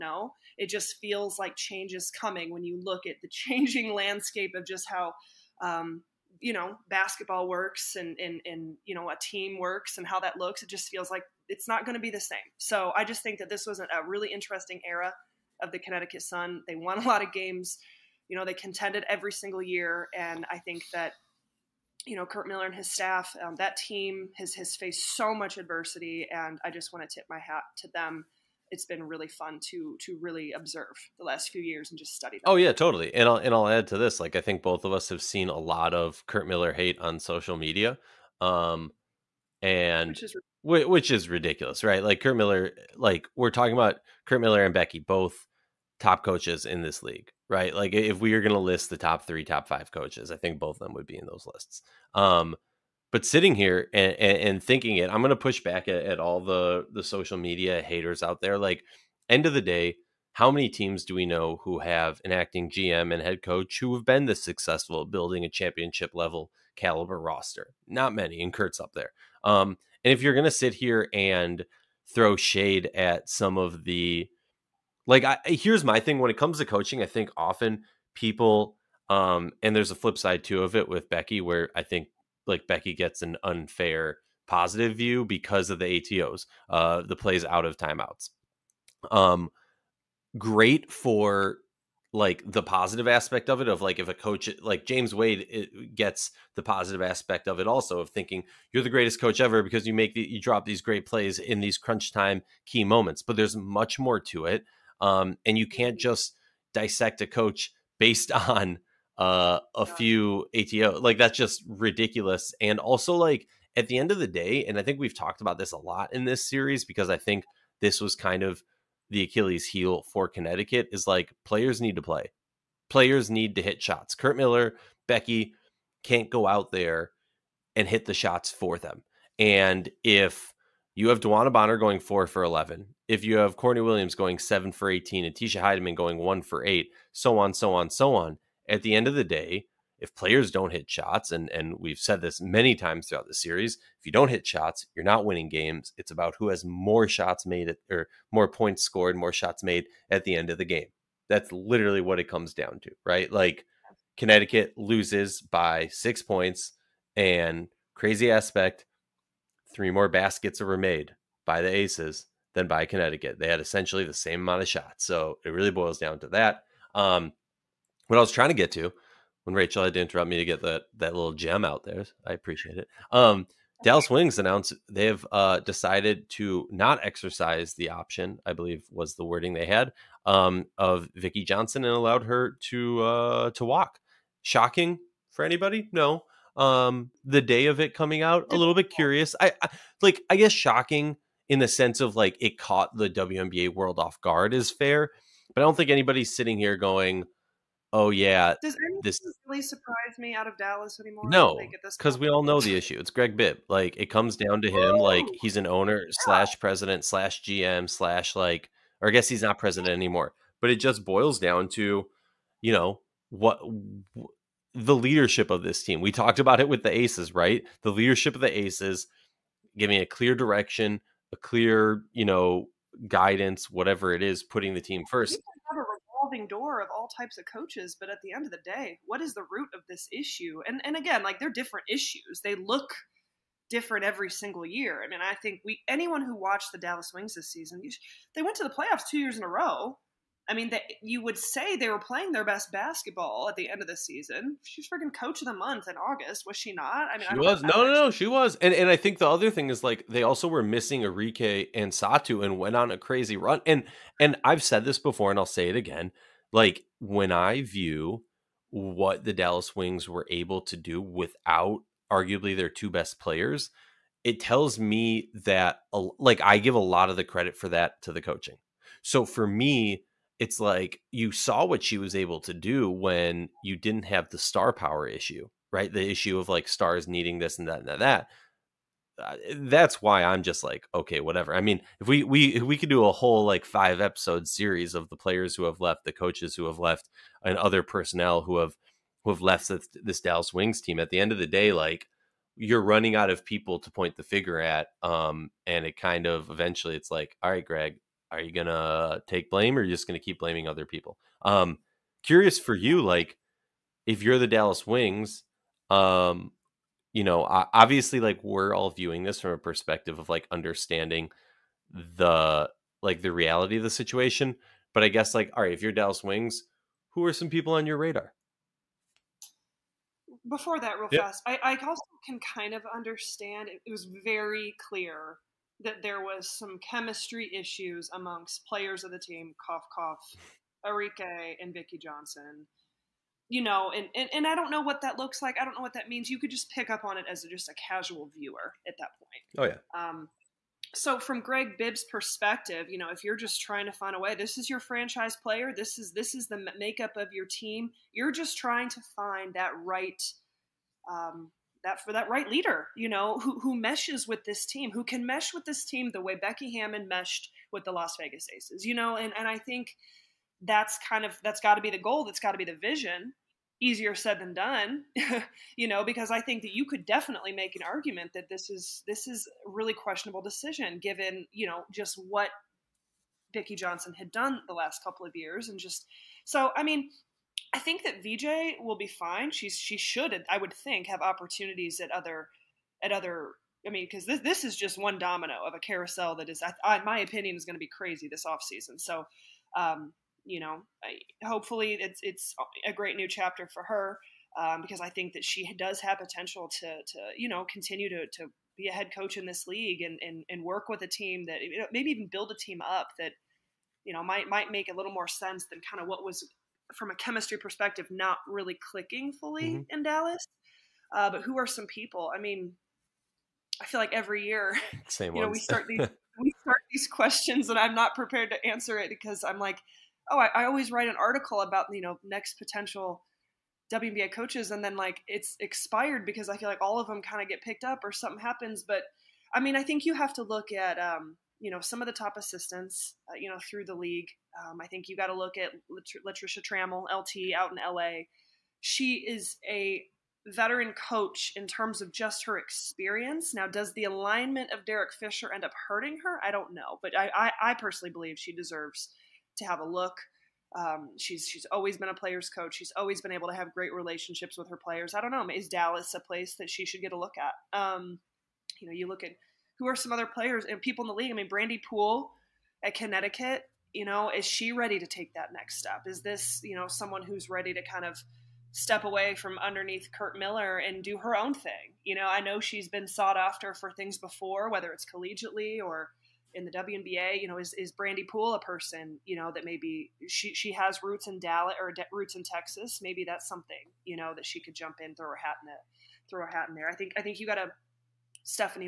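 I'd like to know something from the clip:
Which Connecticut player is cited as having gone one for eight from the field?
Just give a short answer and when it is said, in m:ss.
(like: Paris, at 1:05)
Tisha Hiedeman, at 2:15.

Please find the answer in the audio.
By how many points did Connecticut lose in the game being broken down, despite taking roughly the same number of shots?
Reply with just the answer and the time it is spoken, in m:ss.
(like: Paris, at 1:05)
6, at 2:35.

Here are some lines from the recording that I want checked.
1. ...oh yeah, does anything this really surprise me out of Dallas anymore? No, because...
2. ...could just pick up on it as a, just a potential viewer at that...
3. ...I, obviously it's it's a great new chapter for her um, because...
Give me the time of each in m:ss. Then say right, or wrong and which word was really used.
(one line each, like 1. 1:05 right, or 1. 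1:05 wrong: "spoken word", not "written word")
1. 3:17 right
2. 5:36 wrong: "casual", not "potential"
3. 6:31 wrong: "hopefully", not "obviously".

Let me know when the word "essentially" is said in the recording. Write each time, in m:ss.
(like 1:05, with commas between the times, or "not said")
2:43.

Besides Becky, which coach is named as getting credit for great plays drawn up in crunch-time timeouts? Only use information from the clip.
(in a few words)
James Wade.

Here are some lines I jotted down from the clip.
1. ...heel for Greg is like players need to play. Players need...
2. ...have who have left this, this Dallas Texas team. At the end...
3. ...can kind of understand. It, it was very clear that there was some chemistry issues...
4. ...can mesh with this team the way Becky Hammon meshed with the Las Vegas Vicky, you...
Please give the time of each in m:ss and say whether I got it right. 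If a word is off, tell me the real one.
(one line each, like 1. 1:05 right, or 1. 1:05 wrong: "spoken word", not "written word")
1. 1:59 wrong: "Connecticut", not "Greg"
2. 4:48 wrong: "Wings", not "Texas"
3. 5:22 right
4. 5:55 wrong: "Aces", not "Vicky".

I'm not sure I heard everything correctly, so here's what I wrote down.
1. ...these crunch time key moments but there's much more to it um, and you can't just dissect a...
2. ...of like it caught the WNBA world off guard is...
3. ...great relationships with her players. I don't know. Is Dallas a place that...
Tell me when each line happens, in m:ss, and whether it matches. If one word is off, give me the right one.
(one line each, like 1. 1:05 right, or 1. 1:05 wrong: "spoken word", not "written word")
1. 1:41 right
2. 3:11 right
3. 7:33 right.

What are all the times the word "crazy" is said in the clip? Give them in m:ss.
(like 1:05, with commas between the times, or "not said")
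2:37, 4:12, 6:27.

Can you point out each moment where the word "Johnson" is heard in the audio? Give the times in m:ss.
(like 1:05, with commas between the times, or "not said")
3:01, 5:31, 6:13.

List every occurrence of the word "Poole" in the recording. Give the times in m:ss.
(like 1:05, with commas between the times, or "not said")
7:41, 7:58.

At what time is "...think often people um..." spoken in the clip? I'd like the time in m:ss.
1:17.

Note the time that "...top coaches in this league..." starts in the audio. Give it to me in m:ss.
0:46.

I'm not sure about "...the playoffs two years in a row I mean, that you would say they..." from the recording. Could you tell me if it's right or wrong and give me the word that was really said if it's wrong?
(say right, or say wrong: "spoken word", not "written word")
right.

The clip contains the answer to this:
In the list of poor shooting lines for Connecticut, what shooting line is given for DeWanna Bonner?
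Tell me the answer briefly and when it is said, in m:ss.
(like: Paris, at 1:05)
4 for 11, at 2:11.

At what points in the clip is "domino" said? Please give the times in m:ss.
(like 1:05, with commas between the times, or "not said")
6:25.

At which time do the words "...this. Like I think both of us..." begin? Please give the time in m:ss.
0:33.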